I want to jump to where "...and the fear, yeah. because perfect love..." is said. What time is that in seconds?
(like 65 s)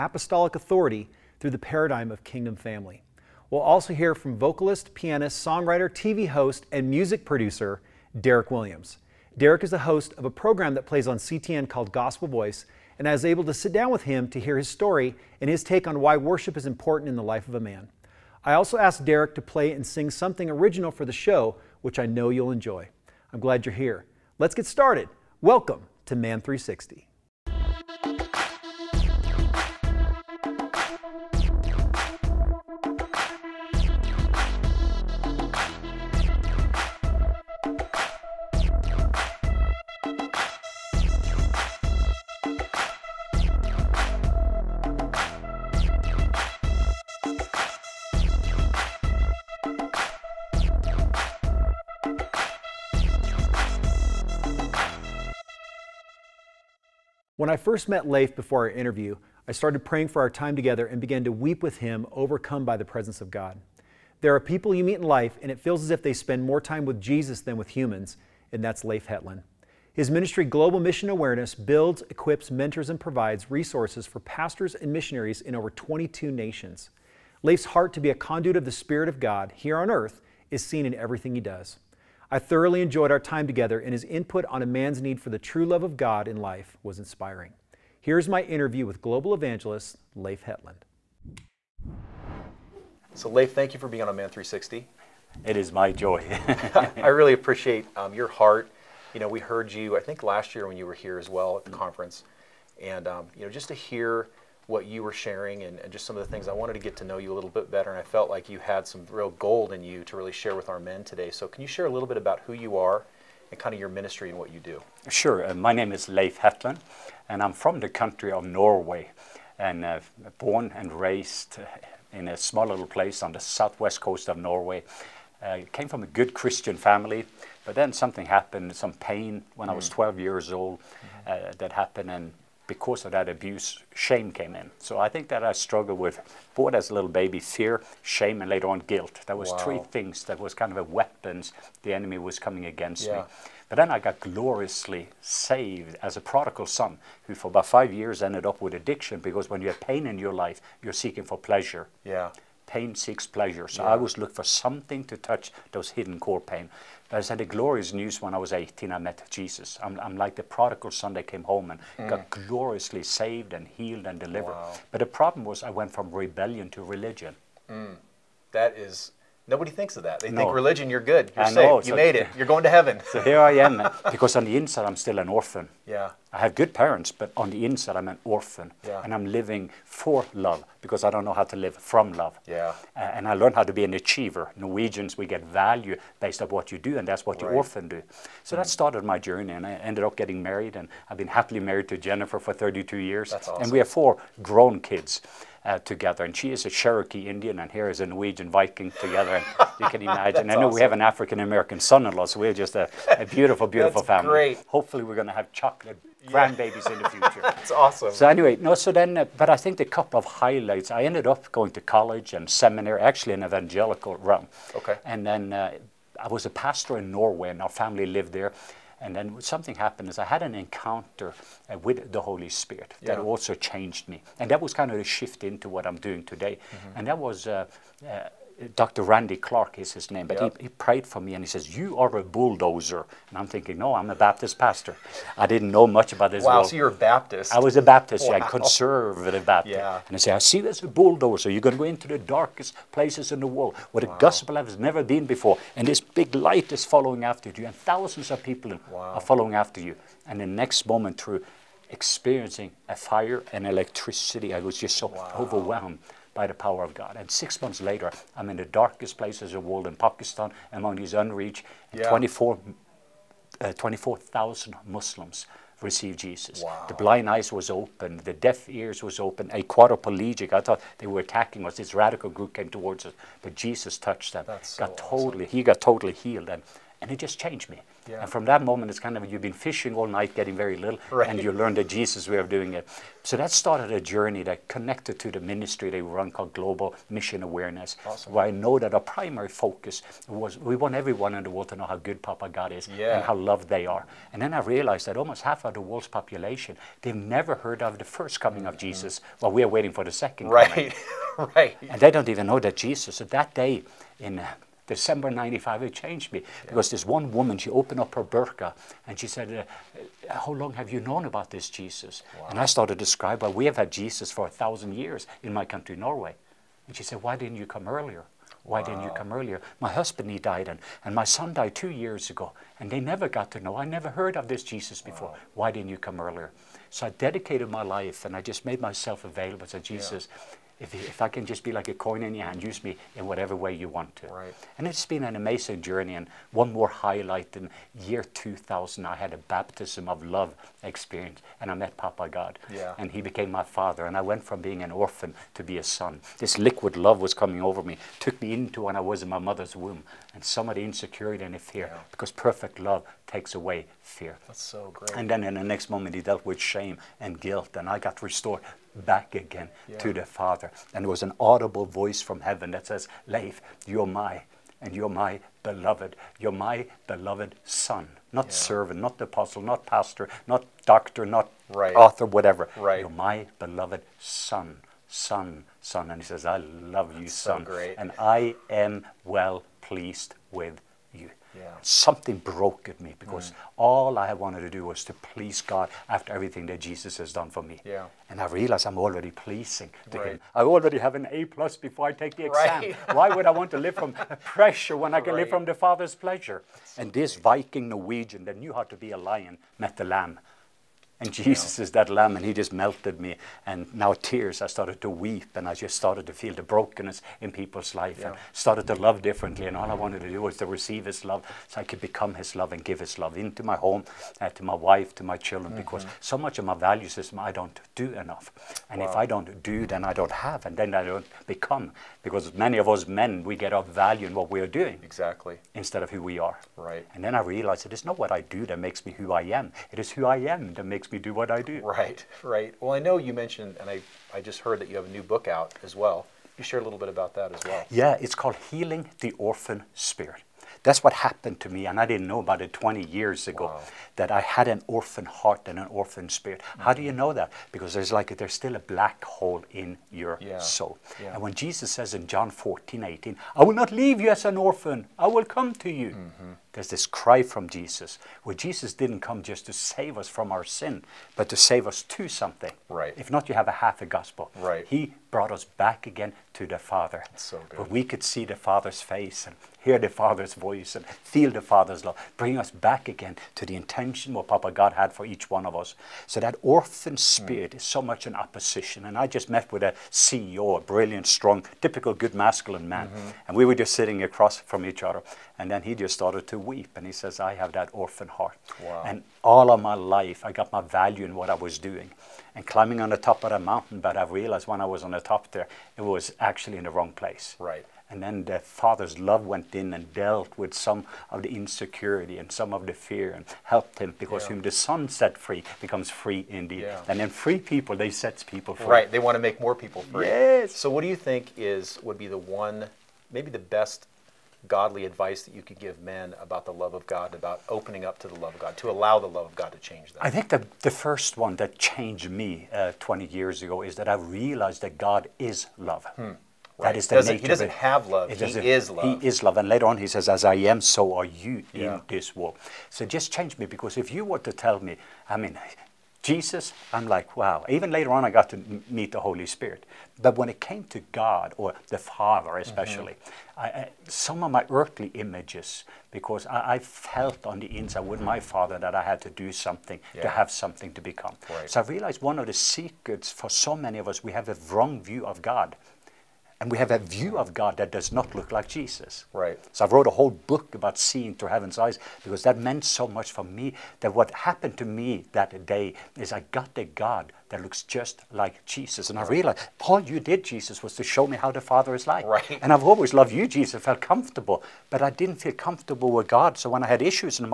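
351 s.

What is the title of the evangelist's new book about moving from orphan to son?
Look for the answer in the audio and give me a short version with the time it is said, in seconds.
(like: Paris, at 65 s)
Healing the Orphan Spirit, at 438 s.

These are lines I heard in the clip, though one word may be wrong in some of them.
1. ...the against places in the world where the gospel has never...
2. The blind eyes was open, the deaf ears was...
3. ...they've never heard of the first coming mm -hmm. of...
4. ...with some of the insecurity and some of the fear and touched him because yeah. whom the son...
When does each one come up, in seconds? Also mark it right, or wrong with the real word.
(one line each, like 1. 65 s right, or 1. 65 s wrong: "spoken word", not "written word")
1. 242 s wrong: "darkest", not "against"
2. 266 s right
3. 297 s right
4. 500 s wrong: "helped", not "touched".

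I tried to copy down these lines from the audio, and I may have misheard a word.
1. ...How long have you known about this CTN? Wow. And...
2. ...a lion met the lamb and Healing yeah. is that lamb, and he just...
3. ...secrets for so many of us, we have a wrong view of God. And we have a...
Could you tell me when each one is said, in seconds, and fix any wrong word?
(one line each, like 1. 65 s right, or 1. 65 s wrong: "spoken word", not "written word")
1. 310 s wrong: "Jesus", not "CTN"
2. 399 s wrong: "Jesus", not "Healing"
3. 552 s right.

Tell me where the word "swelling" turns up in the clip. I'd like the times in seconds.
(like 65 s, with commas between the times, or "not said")
not said.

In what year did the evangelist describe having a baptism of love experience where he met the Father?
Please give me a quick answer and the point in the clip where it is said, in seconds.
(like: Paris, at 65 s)
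2000, at 338 s.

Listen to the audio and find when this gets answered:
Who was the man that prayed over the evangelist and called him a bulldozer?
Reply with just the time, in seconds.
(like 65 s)
228 s.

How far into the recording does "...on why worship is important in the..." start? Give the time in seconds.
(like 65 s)
15 s.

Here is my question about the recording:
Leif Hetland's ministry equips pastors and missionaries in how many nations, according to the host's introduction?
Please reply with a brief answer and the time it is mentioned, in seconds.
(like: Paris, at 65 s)
22, at 75 s.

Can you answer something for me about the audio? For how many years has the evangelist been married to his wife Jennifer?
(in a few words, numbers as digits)
32.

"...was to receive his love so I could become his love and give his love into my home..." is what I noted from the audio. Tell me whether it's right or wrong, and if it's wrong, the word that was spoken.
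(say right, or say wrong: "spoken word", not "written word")
right.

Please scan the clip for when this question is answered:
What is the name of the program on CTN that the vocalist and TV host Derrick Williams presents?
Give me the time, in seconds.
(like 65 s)
11 s.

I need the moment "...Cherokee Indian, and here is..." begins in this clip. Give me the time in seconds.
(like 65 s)
196 s.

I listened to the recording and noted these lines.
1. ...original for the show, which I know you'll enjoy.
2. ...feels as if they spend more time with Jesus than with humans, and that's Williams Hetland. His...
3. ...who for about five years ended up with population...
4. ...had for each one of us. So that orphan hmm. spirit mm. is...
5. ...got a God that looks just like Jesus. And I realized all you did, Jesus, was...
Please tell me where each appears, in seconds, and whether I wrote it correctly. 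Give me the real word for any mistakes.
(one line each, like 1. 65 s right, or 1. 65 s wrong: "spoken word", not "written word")
1. 20 s right
2. 65 s wrong: "Leif", not "Williams"
3. 147 s wrong: "addiction", not "population"
4. 474 s right
5. 566 s right.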